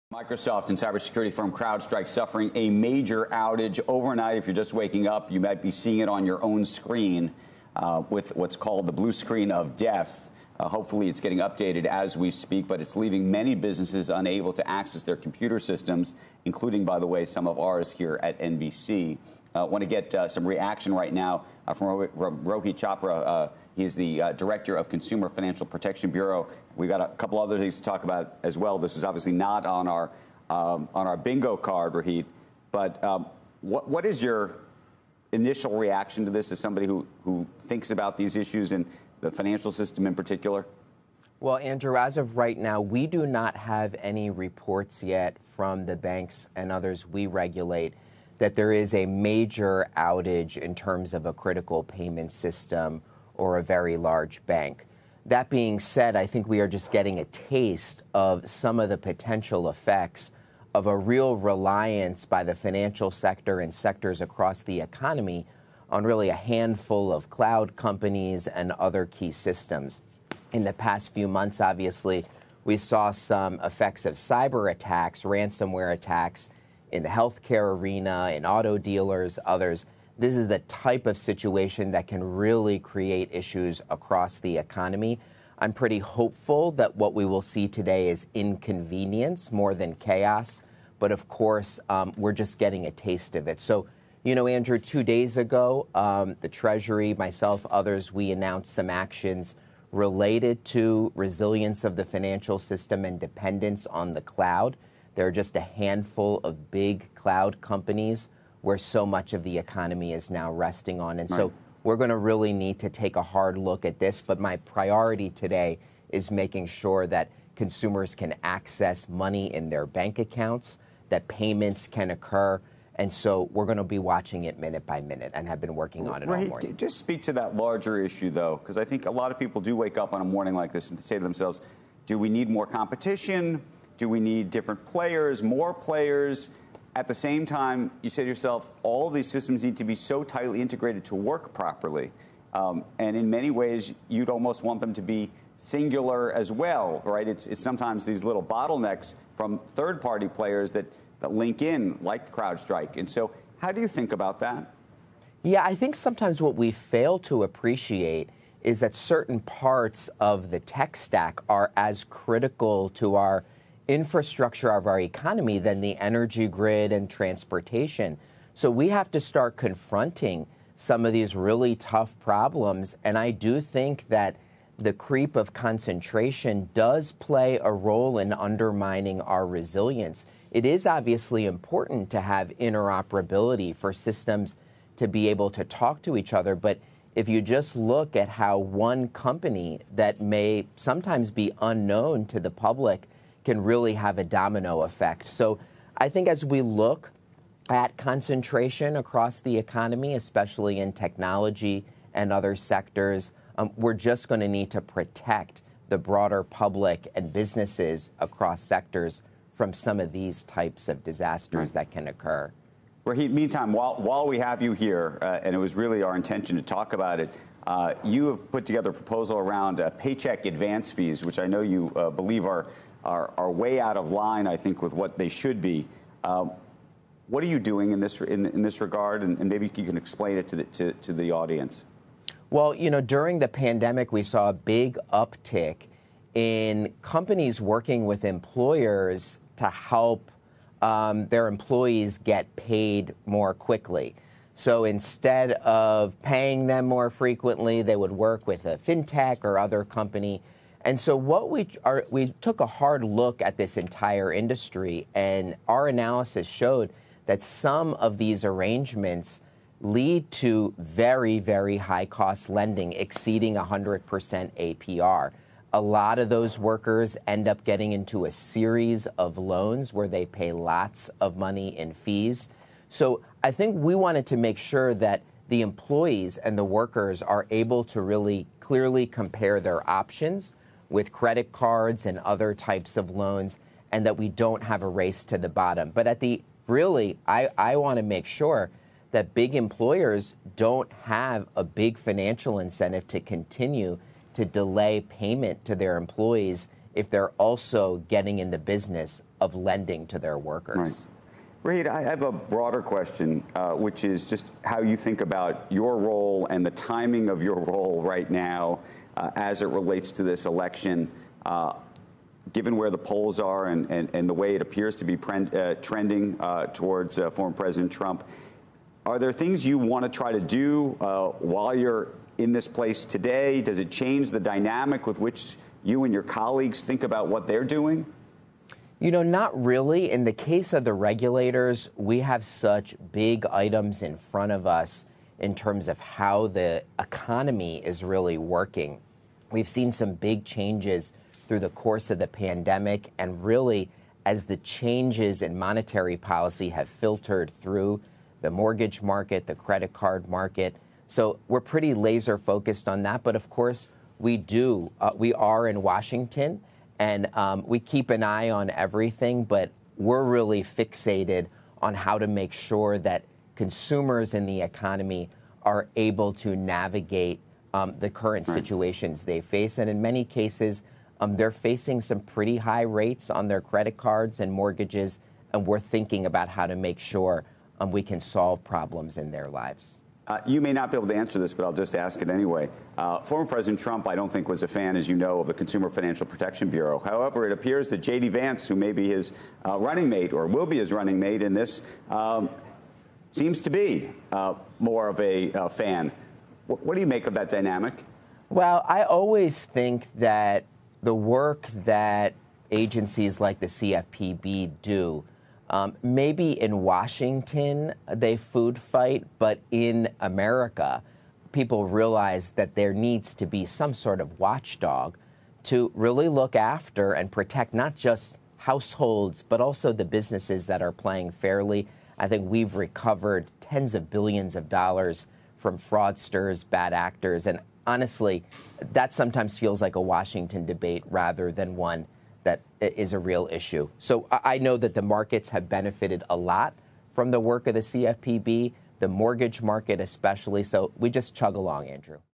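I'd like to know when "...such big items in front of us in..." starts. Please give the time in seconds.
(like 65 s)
332 s.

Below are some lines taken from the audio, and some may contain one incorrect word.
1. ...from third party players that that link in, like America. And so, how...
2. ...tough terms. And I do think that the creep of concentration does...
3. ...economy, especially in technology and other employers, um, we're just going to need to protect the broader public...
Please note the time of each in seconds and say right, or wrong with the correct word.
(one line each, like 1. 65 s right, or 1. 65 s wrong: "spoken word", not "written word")
1. 149 s wrong: "CrowdStrike", not "America"
2. 171 s wrong: "problems", not "terms"
3. 199 s wrong: "sectors", not "employers".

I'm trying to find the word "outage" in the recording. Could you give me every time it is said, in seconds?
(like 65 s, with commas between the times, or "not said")
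3 s, 49 s.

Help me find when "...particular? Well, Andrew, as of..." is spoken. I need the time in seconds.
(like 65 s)
40 s.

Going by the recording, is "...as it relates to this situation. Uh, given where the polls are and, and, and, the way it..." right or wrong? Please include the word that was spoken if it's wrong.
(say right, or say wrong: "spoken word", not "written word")
wrong: "election", not "situation".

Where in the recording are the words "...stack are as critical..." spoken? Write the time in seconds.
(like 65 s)
160 s.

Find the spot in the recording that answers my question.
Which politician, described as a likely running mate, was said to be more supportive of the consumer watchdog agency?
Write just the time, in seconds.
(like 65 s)
387 s.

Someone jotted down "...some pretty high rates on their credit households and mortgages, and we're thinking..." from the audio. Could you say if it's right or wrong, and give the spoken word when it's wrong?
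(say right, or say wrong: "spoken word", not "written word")
wrong: "cards", not "households".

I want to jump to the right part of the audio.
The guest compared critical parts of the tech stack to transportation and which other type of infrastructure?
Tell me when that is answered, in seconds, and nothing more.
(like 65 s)
165 s.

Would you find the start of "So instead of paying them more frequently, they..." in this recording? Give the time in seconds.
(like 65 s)
244 s.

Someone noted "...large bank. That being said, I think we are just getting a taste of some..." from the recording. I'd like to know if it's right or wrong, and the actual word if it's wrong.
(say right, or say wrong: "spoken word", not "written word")
right.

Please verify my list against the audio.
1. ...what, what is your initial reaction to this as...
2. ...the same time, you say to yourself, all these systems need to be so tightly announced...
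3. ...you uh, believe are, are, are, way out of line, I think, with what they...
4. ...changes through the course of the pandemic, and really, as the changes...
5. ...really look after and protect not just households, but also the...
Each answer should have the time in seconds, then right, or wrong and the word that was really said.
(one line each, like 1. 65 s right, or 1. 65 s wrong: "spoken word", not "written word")
1. 33 s right
2. 137 s wrong: "integrated", not "announced"
3. 221 s right
4. 340 s right
5. 415 s right.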